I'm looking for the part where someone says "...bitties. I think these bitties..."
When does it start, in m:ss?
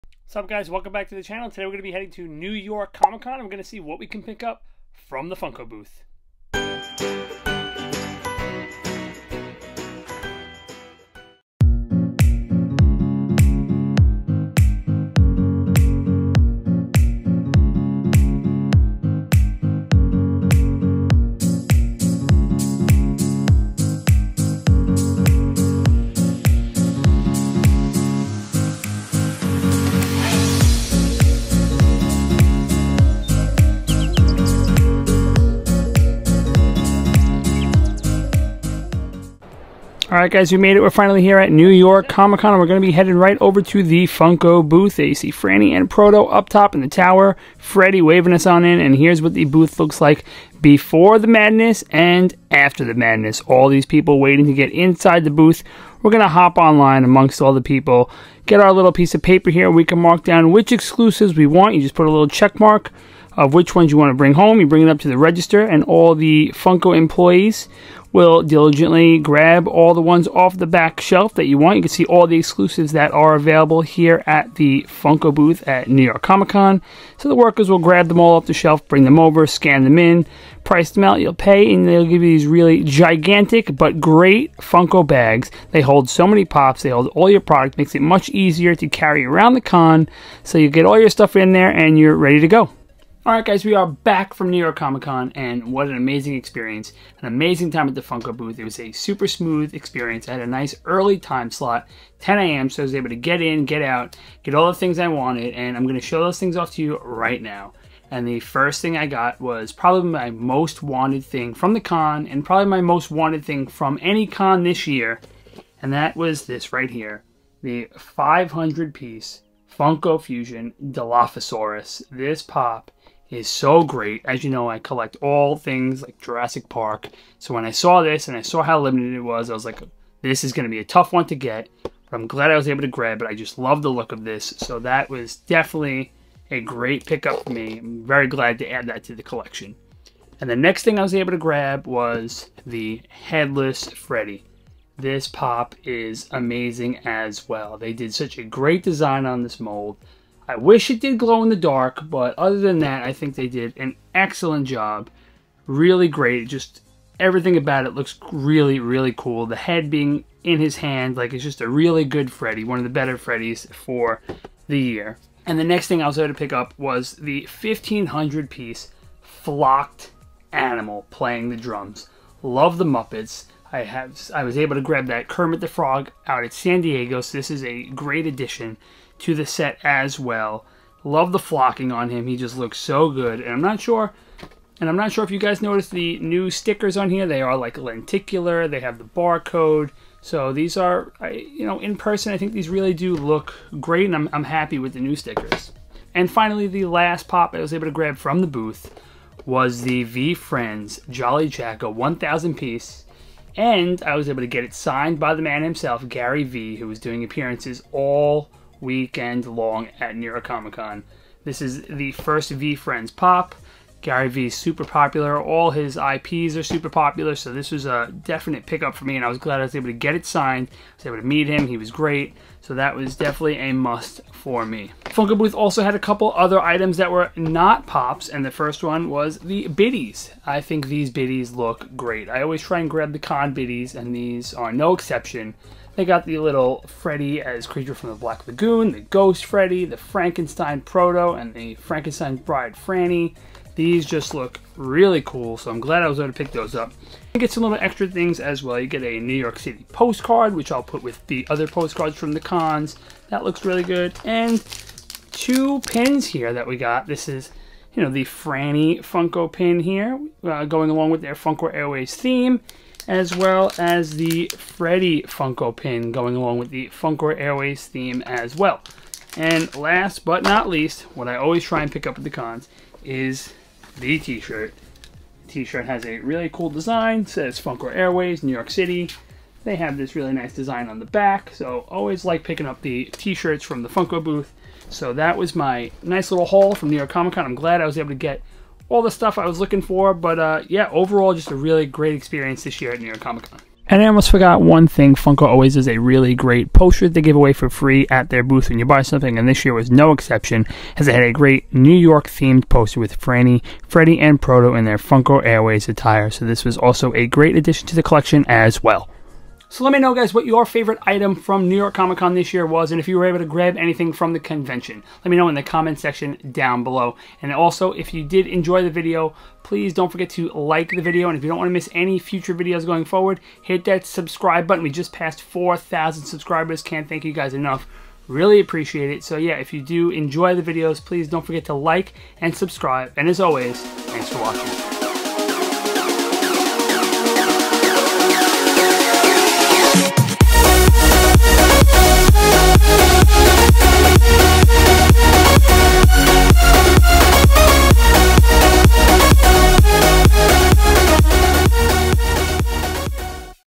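3:49.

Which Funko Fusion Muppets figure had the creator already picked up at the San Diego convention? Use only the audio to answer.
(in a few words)
Kermit the Frog.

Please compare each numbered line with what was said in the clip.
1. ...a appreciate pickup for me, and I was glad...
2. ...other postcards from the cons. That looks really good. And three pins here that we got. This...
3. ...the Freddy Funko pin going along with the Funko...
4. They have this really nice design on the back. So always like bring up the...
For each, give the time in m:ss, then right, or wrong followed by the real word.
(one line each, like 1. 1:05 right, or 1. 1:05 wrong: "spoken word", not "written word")
1. 3:37 wrong: "definite", not "appreciate"
2. 4:11 wrong: "two", not "three"
3. 4:24 right
4. 4:39 wrong: "picking", not "bring".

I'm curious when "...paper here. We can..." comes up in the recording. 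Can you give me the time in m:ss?
0:59.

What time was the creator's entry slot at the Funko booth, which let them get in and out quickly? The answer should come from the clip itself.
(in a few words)
10 a.m.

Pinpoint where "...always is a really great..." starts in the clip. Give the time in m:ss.
4:55.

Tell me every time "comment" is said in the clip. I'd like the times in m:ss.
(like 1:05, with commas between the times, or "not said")
5:15.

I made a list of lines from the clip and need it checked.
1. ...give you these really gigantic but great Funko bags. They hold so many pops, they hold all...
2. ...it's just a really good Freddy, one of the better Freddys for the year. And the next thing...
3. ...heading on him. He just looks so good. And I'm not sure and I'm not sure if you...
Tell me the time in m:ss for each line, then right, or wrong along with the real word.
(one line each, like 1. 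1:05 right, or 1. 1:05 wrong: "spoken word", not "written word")
1. 1:22 right
2. 2:41 right
3. 3:01 wrong: "flocking", not "heading".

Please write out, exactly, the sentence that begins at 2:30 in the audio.
I wish it did glow in the dark, but other than that, I think they did an excellent job.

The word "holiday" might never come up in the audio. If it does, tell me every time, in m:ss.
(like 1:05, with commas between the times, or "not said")
not said.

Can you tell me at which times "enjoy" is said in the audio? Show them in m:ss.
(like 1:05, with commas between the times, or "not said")
5:18, 5:30.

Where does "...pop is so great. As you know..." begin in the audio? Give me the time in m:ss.
2:02.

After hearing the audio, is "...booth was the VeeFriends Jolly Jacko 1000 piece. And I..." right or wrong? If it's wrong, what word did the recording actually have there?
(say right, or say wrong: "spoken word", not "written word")
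right.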